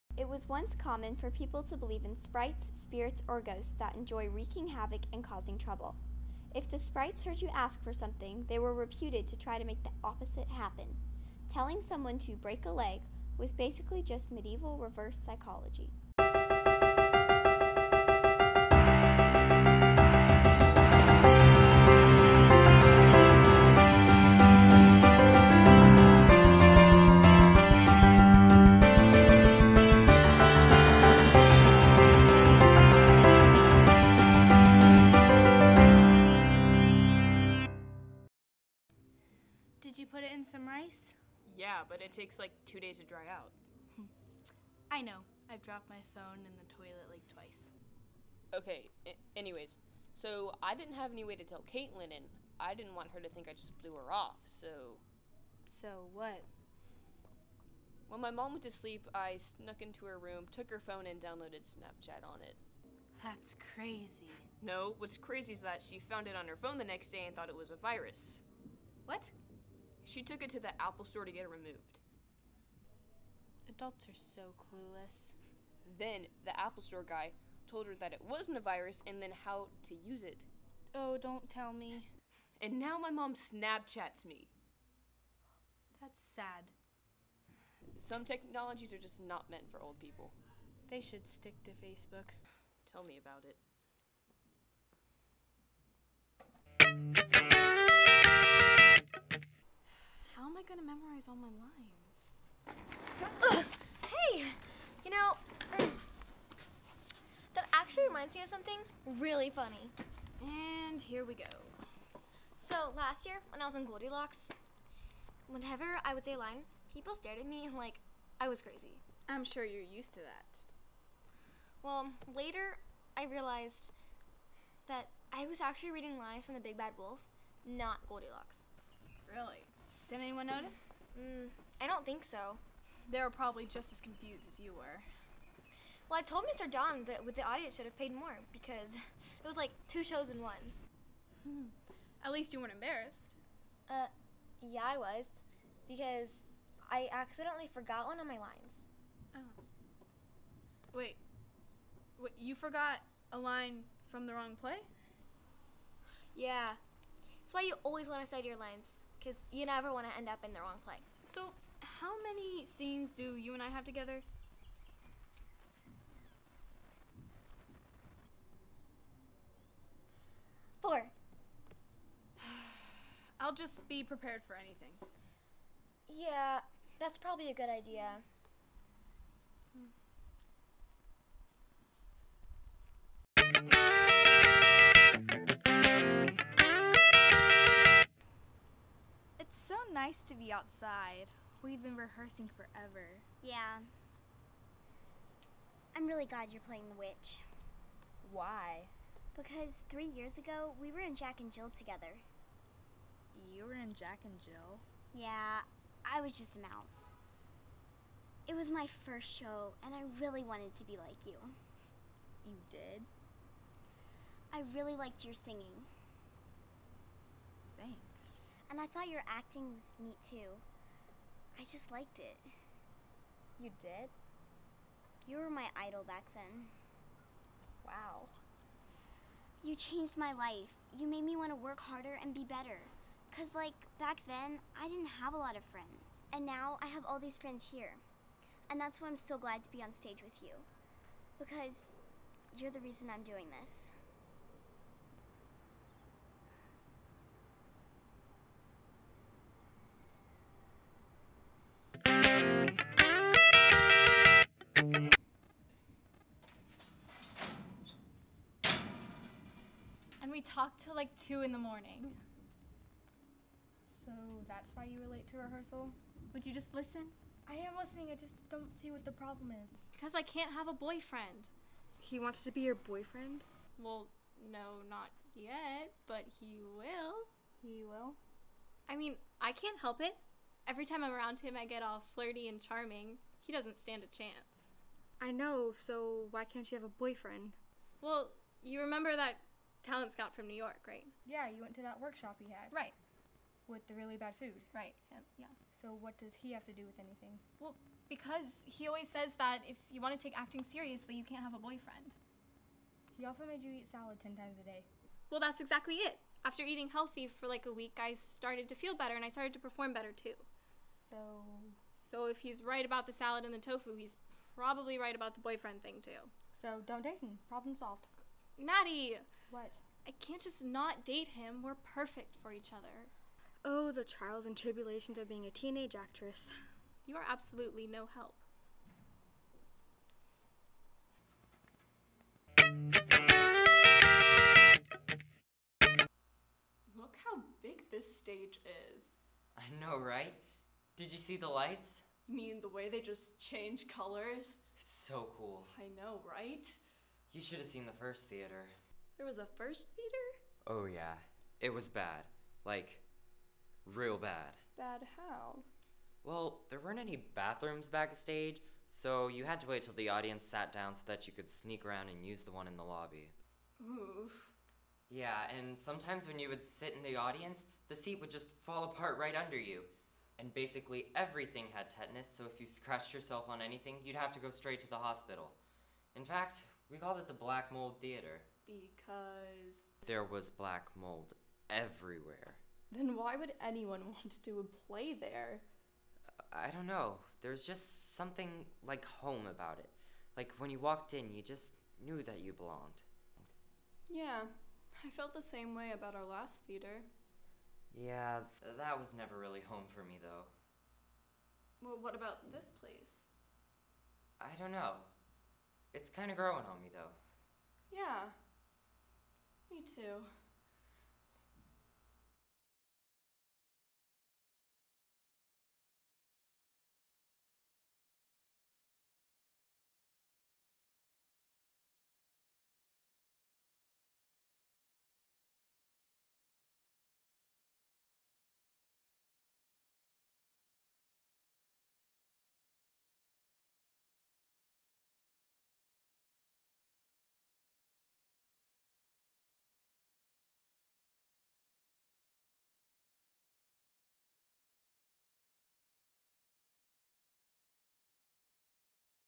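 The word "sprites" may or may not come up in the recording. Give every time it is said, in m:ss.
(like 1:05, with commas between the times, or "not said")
0:02, 0:06.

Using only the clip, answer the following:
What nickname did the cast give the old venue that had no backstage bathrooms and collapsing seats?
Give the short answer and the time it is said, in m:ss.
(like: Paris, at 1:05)
Black Mold Theater, at 6:17.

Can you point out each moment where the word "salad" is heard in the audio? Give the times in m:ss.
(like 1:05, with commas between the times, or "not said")
5:03, 5:13.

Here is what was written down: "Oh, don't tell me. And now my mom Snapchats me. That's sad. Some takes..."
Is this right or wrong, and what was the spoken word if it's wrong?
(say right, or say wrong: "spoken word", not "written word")
wrong: "technologies", not "takes".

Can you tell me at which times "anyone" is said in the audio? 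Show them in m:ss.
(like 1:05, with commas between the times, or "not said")
2:10, 6:23.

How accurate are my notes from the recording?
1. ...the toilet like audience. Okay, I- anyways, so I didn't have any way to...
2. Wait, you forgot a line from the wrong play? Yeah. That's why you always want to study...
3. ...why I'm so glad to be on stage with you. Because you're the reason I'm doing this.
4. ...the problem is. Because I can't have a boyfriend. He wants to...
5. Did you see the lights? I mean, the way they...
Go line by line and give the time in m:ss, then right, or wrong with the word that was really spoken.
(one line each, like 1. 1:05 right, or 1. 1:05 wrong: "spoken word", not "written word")
1. 0:46 wrong: "twice", not "audience"
2. 2:32 right
3. 3:59 right
4. 4:29 right
5. 5:40 right.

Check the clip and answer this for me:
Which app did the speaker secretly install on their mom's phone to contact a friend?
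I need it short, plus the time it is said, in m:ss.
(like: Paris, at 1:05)
Snapchat, at 1:01.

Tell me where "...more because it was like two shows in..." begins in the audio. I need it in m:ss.
2:18.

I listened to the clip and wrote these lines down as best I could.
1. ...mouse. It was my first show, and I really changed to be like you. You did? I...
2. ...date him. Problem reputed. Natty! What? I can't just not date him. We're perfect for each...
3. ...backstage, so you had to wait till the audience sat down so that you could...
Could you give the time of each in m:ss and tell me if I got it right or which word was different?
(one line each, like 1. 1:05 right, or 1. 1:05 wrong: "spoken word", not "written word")
1. 3:26 wrong: "wanted", not "changed"
2. 5:17 wrong: "solved", not "reputed"
3. 5:57 right.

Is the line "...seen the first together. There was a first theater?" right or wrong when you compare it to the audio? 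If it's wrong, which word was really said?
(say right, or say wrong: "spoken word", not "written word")
wrong: "theater", not "together".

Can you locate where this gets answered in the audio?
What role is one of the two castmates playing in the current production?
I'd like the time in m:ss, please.
3:16.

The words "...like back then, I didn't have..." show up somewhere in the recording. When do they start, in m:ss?
3:53.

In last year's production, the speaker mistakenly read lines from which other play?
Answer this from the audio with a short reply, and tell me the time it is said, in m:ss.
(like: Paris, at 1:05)
The Big Bad Wolf, at 2:06.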